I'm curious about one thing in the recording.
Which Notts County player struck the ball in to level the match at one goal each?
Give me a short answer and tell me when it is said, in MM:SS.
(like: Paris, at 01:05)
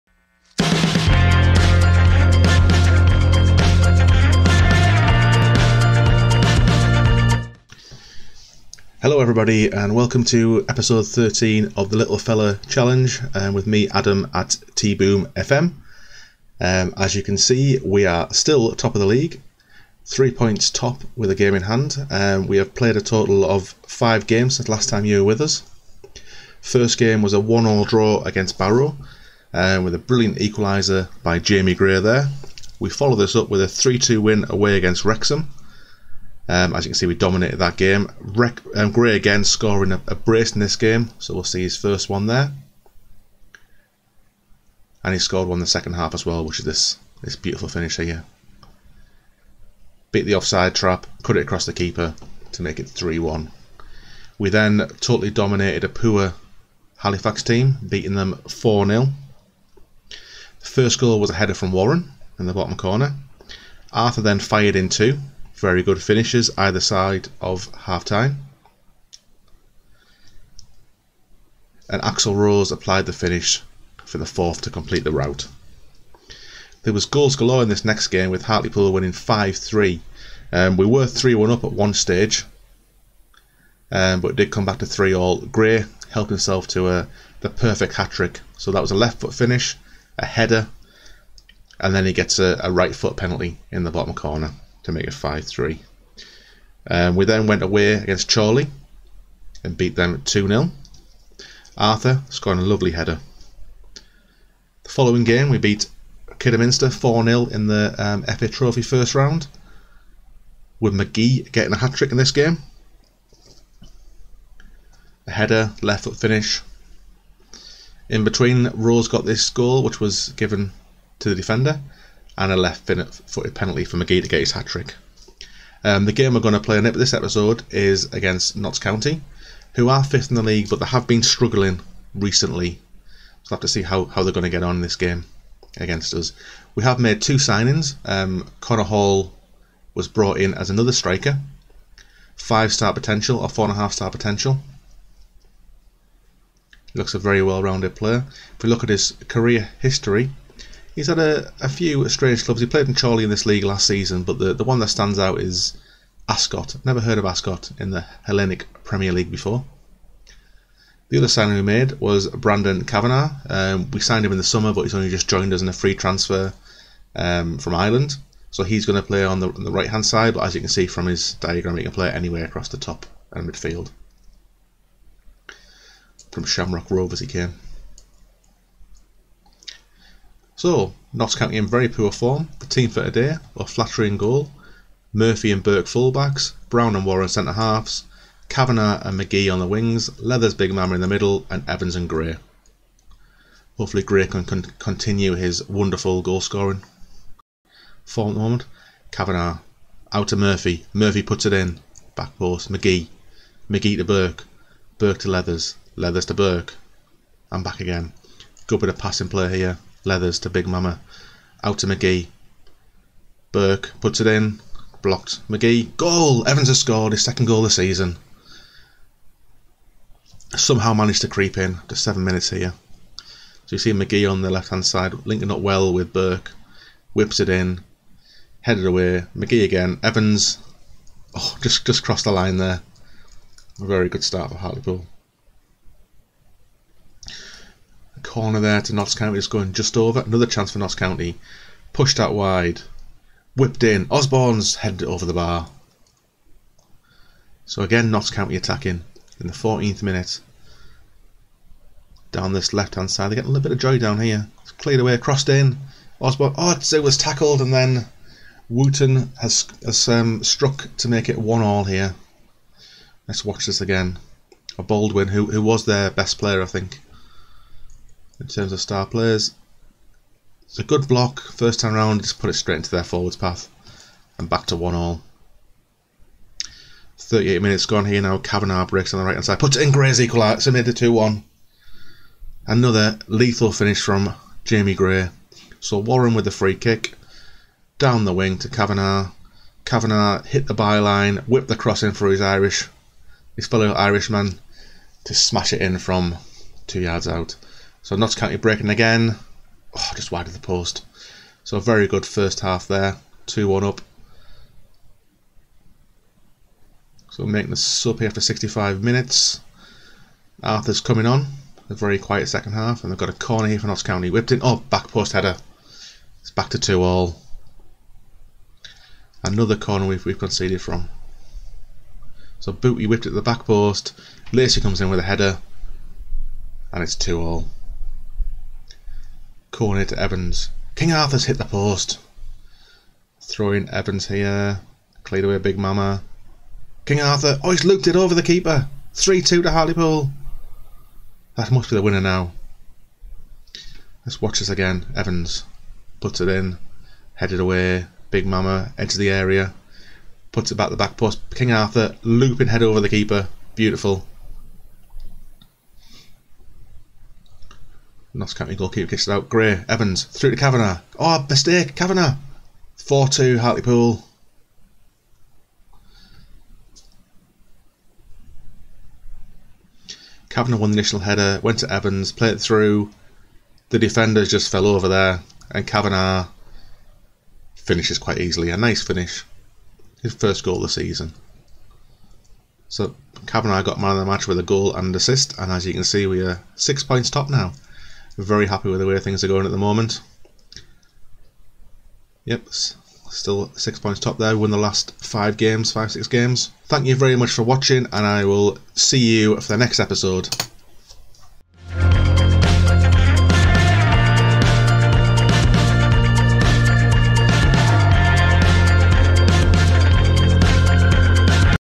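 Wootton, at 04:18.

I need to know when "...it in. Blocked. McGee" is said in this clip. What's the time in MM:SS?
03:34.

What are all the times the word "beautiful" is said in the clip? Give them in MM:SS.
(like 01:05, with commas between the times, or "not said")
00:47, 05:53.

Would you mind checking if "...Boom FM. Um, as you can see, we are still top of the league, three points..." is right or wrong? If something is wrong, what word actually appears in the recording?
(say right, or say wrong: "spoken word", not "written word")
right.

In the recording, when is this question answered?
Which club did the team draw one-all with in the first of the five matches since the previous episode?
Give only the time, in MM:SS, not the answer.
00:28.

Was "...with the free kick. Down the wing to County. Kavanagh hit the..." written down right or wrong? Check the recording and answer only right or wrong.
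wrong.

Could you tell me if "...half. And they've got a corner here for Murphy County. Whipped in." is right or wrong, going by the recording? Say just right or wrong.
wrong.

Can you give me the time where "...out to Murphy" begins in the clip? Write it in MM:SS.
03:20.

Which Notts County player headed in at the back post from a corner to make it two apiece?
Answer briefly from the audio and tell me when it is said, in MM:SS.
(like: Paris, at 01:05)
Lacey, at 05:24.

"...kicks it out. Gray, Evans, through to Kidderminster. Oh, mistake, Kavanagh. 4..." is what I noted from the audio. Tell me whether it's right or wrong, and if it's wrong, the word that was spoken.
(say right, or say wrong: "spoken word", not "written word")
wrong: "Kavanagh", not "Kidderminster".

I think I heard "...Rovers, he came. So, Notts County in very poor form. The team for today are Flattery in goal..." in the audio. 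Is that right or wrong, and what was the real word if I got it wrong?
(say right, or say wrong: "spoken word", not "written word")
right.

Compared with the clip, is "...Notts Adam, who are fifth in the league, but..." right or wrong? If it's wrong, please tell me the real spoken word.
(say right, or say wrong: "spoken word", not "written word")
wrong: "County", not "Adam".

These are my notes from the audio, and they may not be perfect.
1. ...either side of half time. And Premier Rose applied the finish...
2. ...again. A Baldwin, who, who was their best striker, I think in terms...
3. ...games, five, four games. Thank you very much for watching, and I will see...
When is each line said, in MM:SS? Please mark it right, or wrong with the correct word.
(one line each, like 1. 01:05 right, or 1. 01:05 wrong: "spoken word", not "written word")
1. 01:06 wrong: "Axel", not "Premier"
2. 04:23 wrong: "player", not "striker"
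3. 06:35 wrong: "six", not "four".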